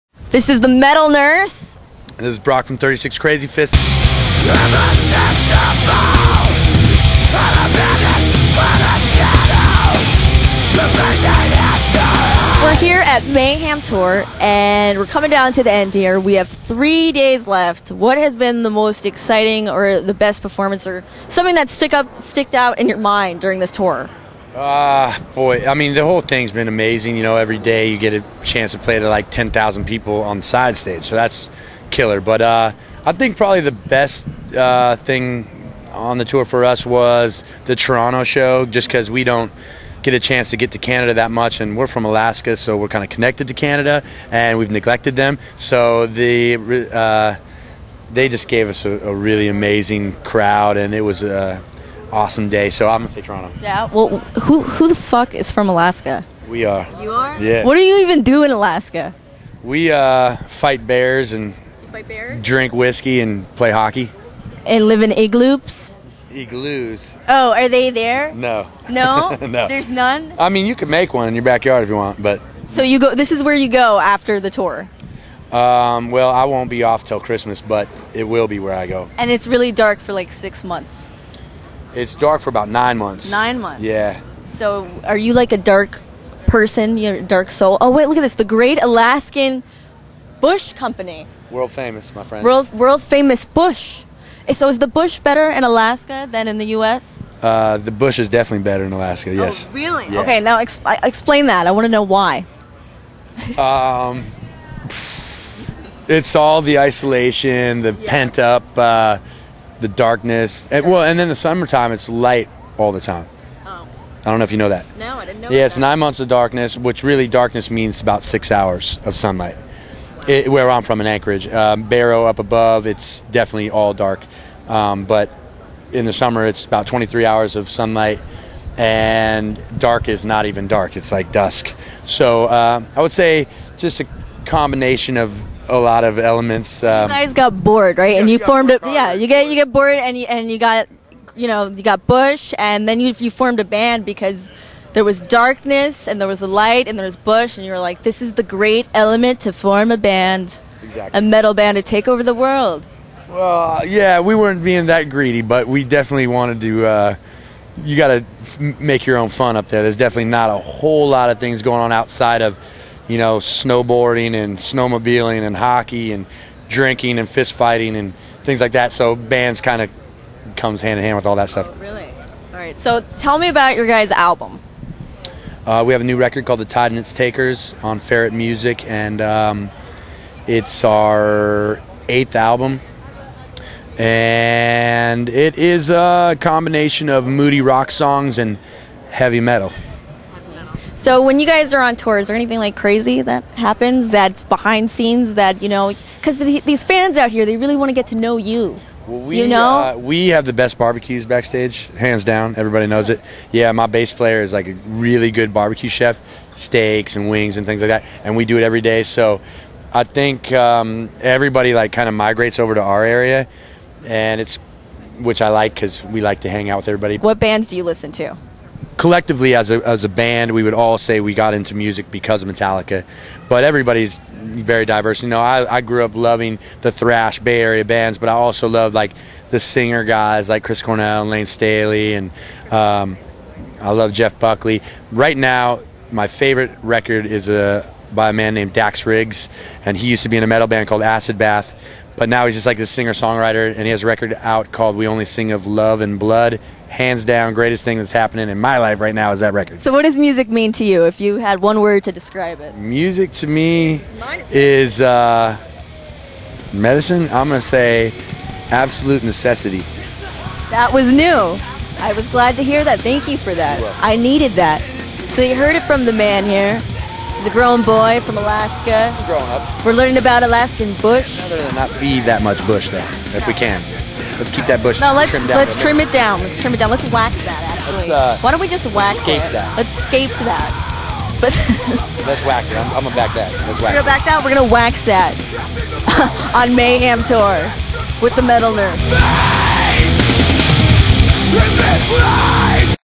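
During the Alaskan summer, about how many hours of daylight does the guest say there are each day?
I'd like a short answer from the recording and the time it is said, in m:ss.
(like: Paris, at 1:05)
23 hours, at 2:06.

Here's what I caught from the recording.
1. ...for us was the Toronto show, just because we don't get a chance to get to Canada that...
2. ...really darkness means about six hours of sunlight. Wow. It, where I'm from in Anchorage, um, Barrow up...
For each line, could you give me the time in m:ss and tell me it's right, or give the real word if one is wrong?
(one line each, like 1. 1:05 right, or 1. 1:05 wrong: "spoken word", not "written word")
1. 0:36 right
2. 1:57 right.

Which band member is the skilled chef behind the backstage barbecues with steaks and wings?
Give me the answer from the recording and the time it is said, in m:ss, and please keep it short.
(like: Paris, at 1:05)
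bass player, at 3:23.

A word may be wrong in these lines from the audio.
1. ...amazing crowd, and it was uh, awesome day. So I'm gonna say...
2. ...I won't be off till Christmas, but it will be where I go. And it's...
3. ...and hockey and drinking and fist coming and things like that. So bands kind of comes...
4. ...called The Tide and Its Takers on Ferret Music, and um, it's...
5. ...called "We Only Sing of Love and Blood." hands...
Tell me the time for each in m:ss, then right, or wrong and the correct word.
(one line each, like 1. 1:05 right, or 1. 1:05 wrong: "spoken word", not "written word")
1. 0:49 right
2. 1:16 right
3. 2:45 wrong: "fighting", not "coming"
4. 2:56 right
5. 4:04 right.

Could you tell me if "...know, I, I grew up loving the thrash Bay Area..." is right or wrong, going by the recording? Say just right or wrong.
right.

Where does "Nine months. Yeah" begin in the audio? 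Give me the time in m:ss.
1:23.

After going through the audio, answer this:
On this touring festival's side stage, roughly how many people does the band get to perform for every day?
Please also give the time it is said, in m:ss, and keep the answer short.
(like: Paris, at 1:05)
10,000, at 0:29.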